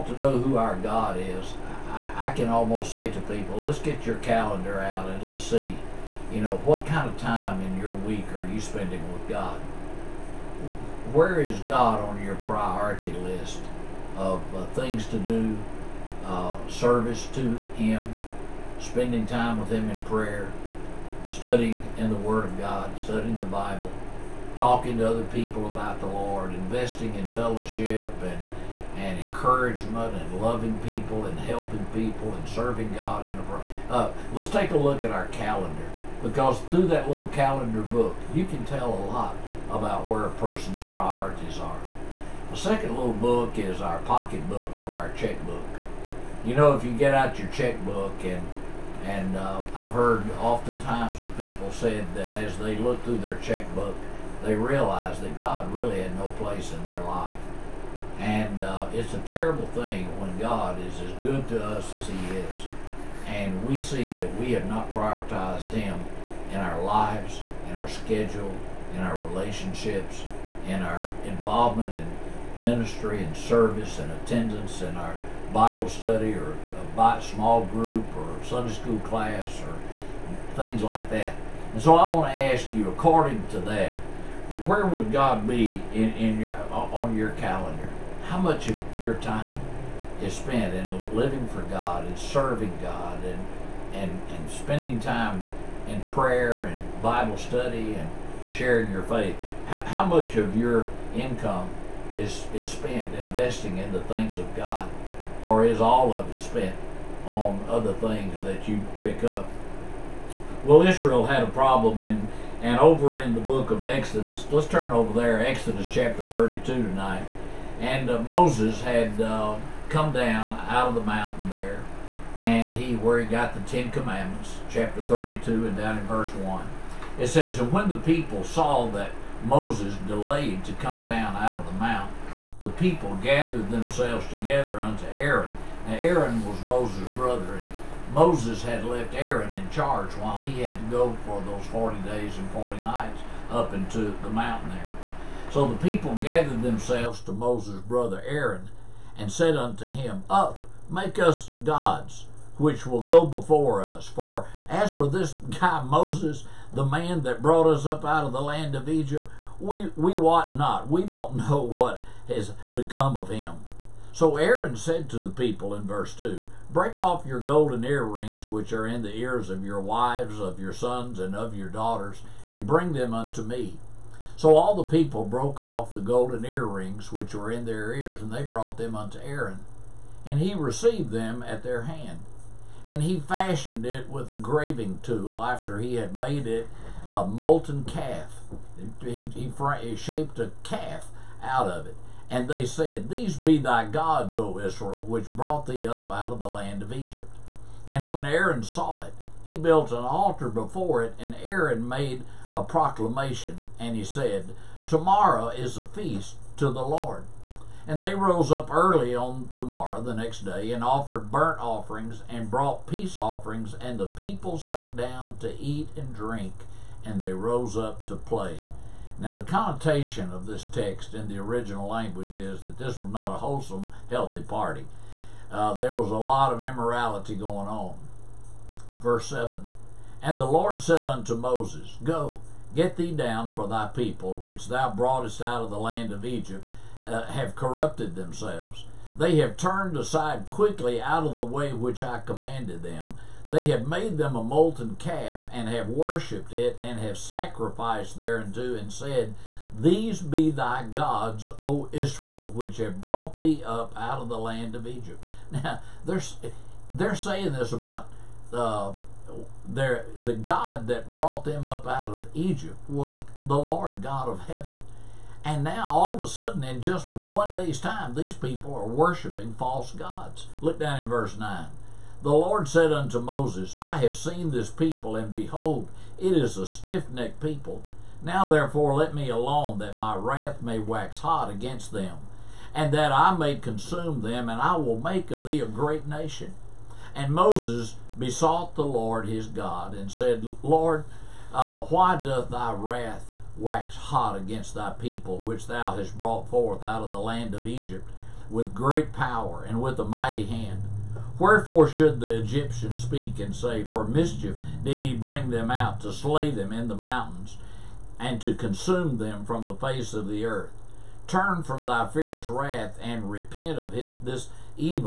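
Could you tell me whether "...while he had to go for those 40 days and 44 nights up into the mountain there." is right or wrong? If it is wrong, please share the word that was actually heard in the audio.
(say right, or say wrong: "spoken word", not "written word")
wrong: "40", not "44".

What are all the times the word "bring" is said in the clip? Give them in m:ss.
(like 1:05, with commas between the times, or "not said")
2:52, 5:05.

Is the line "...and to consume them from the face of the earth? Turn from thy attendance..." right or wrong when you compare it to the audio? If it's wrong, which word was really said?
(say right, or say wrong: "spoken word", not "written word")
wrong: "fierce", not "attendance".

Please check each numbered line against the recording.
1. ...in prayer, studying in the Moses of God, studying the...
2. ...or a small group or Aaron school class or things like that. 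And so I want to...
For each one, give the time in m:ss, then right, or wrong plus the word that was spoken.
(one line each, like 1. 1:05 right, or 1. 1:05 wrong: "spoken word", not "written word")
1. 0:19 wrong: "Word", not "Moses"
2. 1:16 wrong: "Sunday", not "Aaron".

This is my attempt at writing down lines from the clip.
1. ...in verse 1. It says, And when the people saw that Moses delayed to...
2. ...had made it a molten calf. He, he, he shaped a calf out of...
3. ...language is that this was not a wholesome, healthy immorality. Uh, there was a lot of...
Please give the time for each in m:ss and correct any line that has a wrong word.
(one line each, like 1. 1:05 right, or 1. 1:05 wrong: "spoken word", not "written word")
1. 2:05 right
2. 3:05 right
3. 3:41 wrong: "party", not "immorality".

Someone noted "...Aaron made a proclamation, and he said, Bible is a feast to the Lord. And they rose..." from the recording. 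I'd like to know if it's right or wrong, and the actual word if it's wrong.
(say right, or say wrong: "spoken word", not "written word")
wrong: "Tomorrow", not "Bible".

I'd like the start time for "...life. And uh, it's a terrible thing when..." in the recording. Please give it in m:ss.
0:57.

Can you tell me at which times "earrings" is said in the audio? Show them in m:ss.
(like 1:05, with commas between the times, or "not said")
2:47, 2:56.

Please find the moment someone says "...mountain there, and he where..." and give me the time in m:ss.
2:01.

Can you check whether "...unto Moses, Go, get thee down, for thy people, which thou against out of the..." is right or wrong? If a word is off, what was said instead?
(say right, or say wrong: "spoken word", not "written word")
wrong: "broughtest", not "against".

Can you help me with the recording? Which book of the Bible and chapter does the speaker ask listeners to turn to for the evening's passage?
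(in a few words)
Exodus 32.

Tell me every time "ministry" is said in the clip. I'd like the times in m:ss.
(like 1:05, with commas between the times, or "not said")
1:12.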